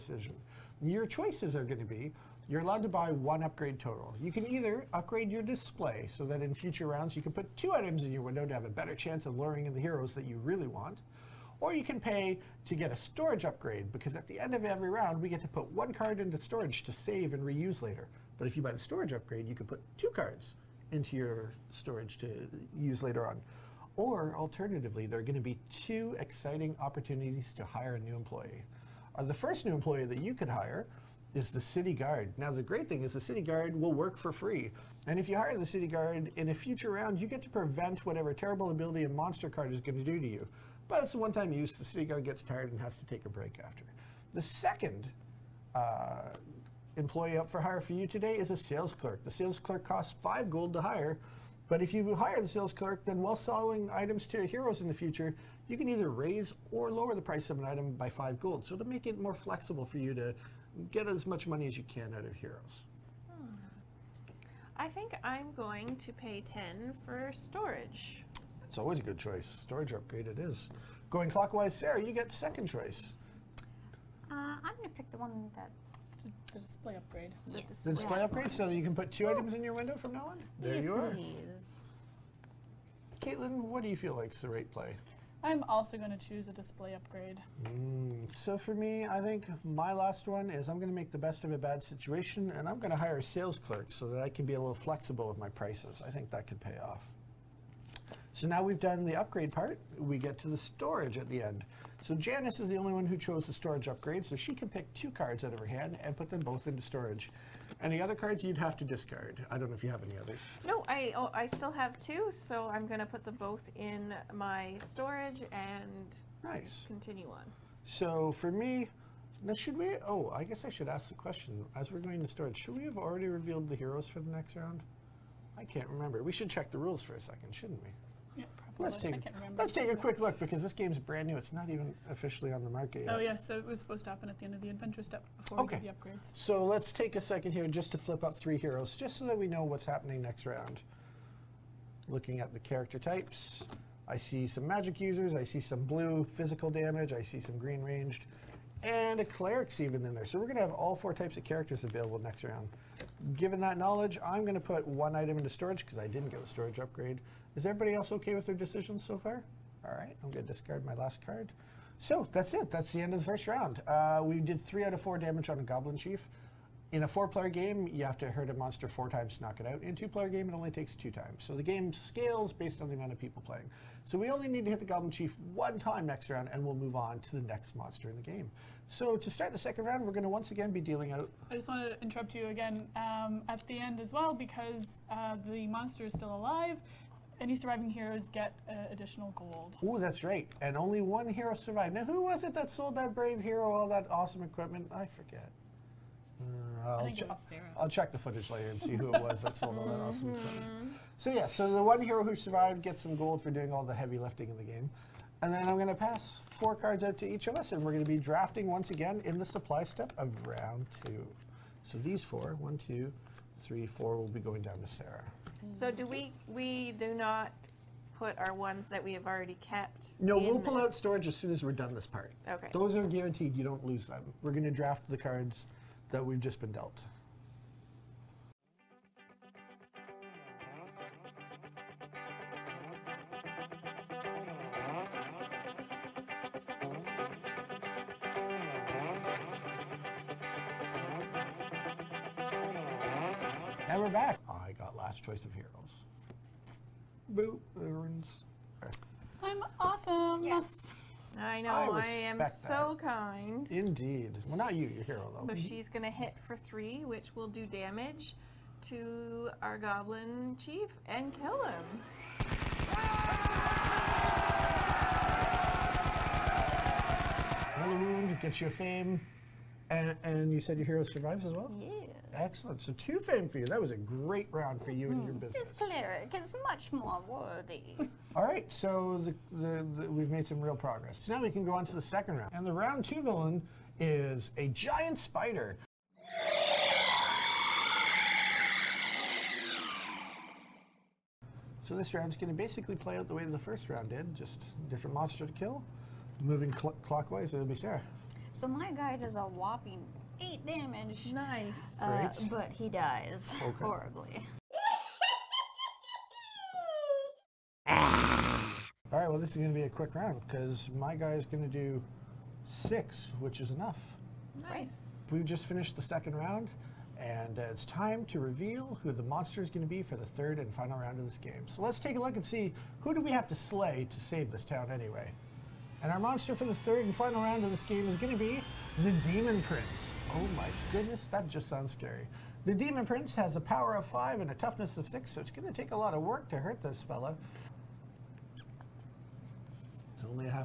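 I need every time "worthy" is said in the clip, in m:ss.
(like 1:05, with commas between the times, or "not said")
4:37.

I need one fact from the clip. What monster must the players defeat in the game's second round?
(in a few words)
Giant spider.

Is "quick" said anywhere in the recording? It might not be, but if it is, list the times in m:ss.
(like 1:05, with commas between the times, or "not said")
2:09, 5:09.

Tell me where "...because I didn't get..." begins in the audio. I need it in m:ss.
2:35.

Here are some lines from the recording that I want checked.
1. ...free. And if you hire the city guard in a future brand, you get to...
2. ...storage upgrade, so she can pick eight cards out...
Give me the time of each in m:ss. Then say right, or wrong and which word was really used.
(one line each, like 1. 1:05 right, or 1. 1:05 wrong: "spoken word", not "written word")
1. 0:34 wrong: "round", not "brand"
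2. 1:43 wrong: "two", not "eight".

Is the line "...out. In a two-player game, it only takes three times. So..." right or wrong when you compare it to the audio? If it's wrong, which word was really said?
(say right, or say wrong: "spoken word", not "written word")
wrong: "two", not "three".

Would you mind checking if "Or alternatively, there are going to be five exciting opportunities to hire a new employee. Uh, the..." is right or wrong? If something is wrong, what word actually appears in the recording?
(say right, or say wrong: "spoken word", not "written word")
wrong: "two", not "five".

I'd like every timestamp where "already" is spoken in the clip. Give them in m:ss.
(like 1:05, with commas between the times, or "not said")
2:02, 3:39.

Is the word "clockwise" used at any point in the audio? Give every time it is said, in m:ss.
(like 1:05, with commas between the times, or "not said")
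1:11, 4:57.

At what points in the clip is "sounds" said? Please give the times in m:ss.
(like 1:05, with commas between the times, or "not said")
5:31.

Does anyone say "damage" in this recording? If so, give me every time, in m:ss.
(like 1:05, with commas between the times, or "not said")
2:26, 2:45, 4:17, 5:00.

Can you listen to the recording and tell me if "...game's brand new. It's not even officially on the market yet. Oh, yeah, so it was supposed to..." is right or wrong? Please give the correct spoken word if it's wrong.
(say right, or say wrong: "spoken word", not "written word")
right.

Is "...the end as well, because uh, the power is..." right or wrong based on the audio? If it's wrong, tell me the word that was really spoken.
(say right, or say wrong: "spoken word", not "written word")
wrong: "monster", not "power".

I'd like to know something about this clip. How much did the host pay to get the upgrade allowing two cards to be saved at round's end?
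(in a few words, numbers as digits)
10.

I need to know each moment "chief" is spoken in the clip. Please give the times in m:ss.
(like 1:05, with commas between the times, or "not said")
2:45, 2:55, 4:20.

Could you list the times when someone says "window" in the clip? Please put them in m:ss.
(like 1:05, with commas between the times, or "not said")
0:08, 1:19.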